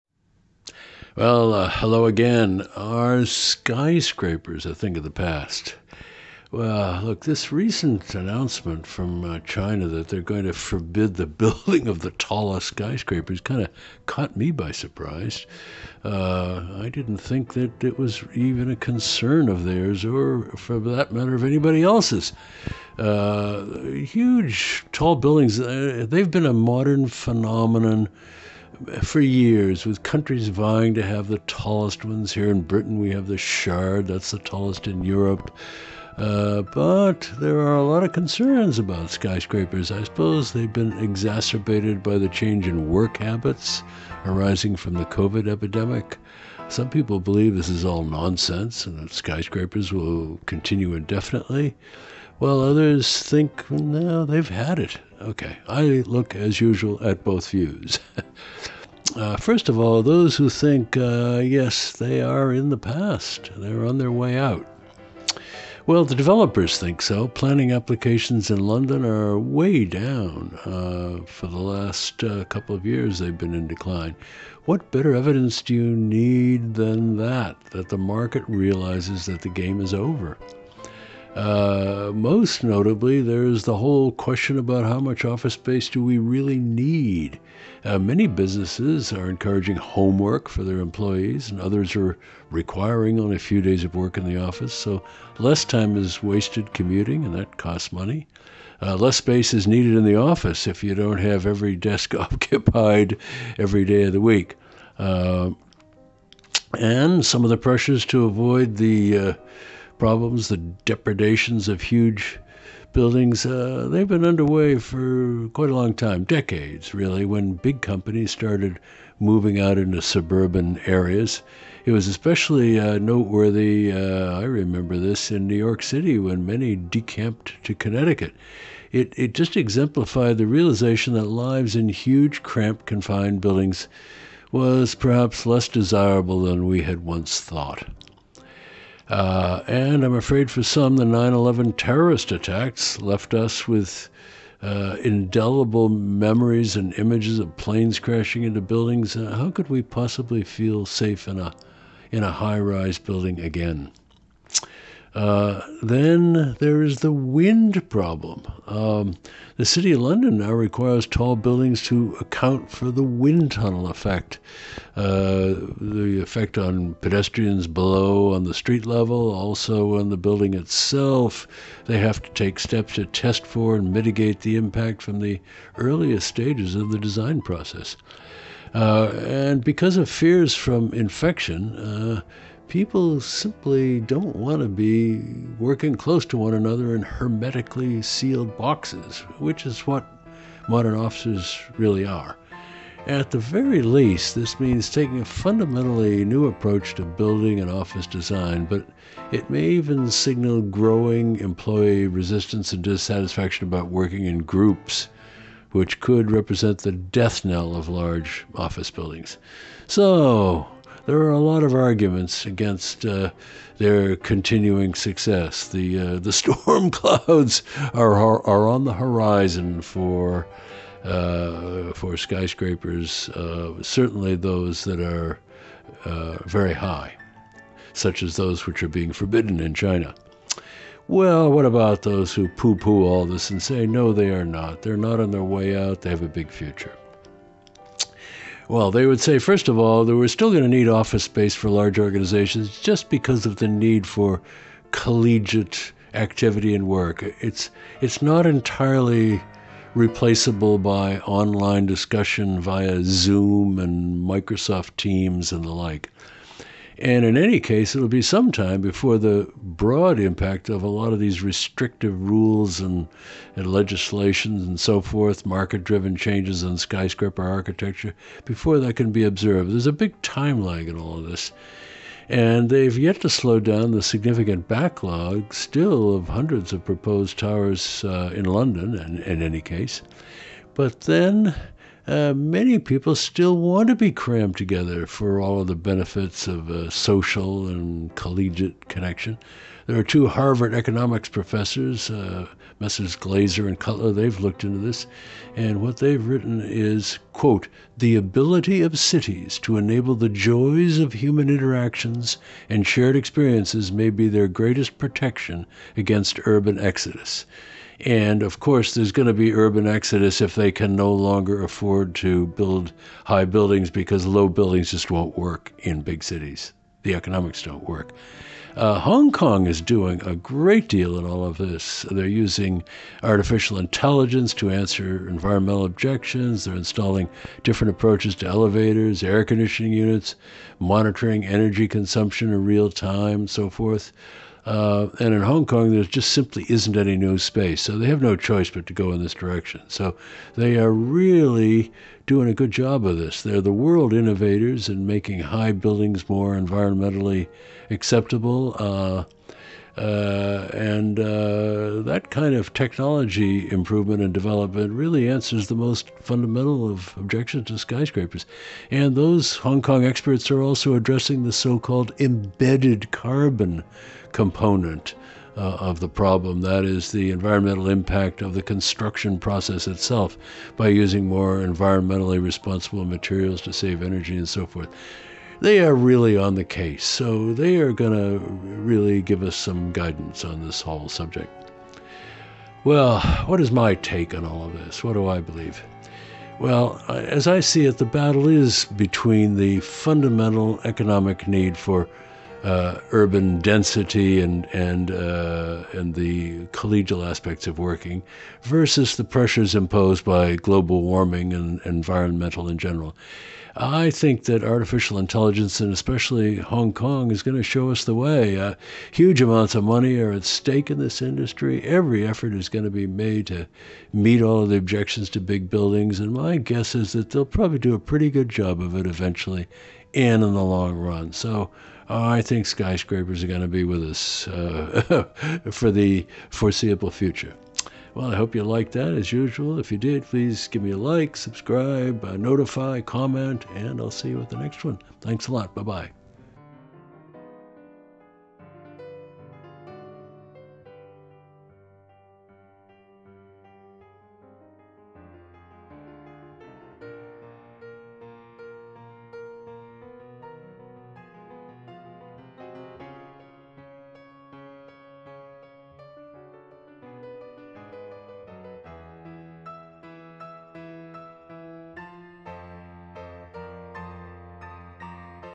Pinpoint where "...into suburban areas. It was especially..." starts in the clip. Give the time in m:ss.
1:59.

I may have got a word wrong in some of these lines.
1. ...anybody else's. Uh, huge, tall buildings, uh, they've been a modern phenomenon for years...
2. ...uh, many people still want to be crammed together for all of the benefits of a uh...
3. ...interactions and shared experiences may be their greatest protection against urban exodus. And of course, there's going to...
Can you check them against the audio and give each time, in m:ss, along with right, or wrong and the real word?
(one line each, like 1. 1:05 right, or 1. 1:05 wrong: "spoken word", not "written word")
1. 0:21 right
2. 4:42 right
3. 5:01 right.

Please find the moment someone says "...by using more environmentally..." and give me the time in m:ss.
6:10.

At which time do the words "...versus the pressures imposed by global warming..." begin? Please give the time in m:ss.
6:38.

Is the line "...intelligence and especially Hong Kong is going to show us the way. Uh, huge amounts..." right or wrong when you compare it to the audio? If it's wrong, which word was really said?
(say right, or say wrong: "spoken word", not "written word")
right.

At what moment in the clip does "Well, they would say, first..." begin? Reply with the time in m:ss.
3:58.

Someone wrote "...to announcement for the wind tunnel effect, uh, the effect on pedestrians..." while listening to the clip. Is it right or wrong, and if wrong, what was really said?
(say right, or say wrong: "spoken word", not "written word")
wrong: "account", not "announcement".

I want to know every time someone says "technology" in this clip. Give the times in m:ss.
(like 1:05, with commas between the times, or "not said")
5:52.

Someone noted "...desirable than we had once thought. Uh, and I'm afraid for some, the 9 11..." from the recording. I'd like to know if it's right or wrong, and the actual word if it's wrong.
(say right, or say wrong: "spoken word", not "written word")
right.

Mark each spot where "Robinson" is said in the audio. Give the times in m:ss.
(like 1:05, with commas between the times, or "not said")
not said.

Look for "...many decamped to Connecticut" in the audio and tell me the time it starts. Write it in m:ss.
2:06.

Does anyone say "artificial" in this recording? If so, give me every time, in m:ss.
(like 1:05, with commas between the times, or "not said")
5:23, 6:44.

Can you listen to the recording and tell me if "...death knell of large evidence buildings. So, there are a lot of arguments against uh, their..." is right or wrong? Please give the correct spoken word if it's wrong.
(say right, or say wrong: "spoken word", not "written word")
wrong: "office", not "evidence".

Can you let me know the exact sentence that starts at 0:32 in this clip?
Here in Britain, we have the Shard, that's the tallest in Europe.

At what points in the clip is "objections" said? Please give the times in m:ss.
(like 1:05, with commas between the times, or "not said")
5:25, 5:57, 6:54.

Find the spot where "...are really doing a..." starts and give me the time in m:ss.
5:40.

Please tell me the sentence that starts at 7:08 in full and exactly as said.
Well, I hope you liked that as usual.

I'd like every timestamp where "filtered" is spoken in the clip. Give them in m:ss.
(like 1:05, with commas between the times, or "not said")
not said.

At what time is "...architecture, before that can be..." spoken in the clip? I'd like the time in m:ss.
4:27.